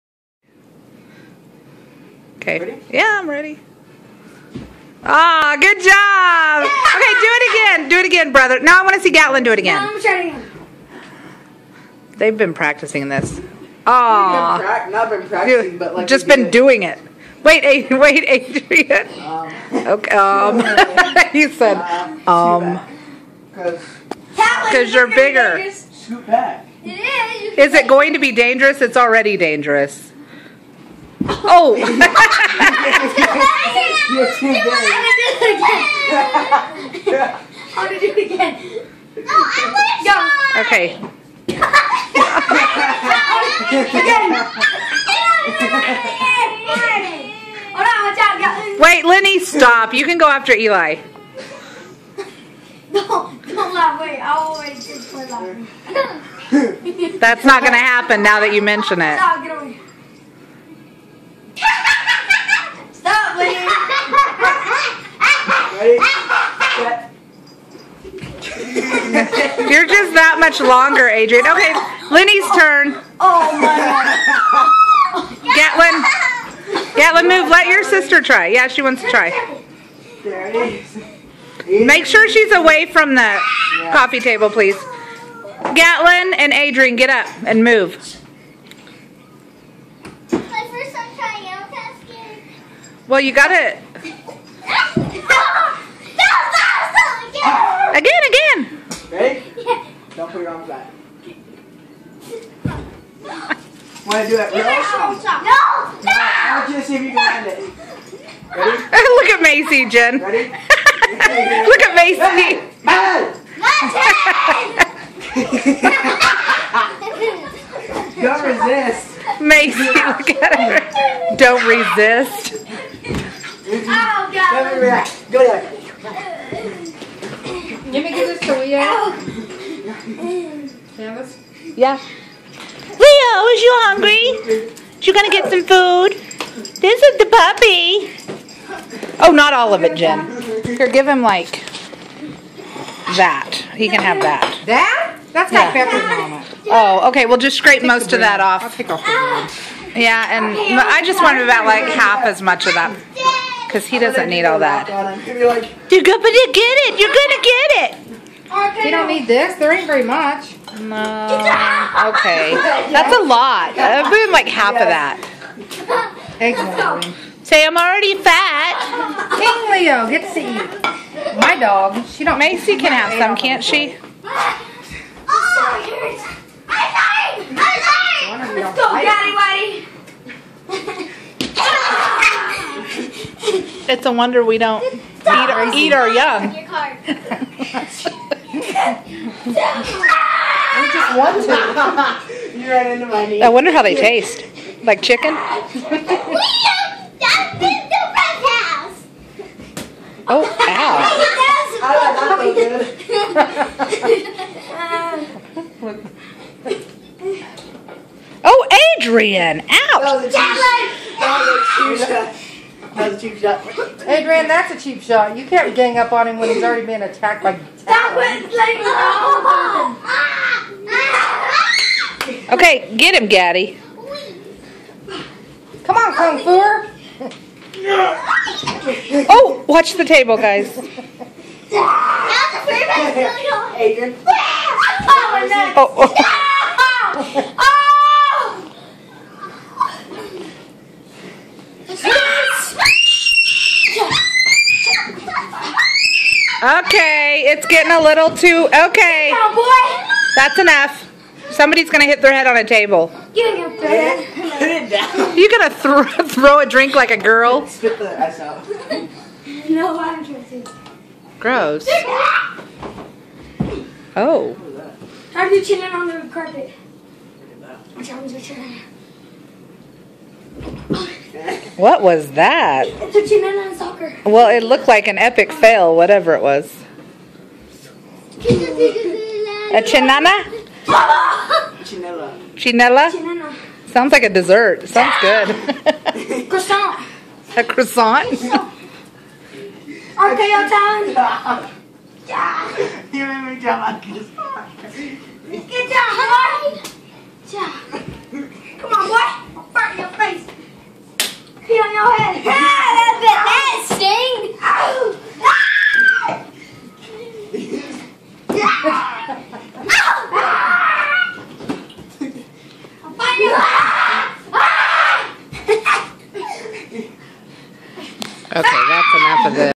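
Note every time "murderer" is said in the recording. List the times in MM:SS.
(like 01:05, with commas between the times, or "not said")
not said.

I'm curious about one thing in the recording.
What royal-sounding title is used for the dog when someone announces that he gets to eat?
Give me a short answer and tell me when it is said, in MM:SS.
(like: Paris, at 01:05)
King Leo, at 02:49.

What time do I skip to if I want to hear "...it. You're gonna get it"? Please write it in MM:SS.
02:36.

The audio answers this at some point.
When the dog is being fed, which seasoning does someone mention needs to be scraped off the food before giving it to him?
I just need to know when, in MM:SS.
02:26.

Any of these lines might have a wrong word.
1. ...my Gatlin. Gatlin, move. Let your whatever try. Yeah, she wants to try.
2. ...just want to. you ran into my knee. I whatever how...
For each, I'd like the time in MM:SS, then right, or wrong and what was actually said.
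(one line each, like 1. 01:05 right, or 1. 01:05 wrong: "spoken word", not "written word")
1. 01:13 wrong: "sister", not "whatever"
2. 03:10 wrong: "wonder", not "whatever".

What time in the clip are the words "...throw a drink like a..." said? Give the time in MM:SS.
04:16.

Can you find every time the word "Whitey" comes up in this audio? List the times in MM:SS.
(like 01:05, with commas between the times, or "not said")
03:03.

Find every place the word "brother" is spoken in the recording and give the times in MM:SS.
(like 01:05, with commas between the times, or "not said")
00:08.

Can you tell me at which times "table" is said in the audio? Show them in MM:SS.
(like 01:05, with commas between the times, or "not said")
01:24, 03:50, 04:12.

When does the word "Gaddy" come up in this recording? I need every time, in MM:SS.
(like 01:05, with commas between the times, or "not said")
03:43.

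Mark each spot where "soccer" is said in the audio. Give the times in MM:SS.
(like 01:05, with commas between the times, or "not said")
04:33.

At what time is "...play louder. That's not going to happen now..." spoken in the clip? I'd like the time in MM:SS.
00:55.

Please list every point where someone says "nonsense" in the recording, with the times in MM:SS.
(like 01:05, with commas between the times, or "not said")
not said.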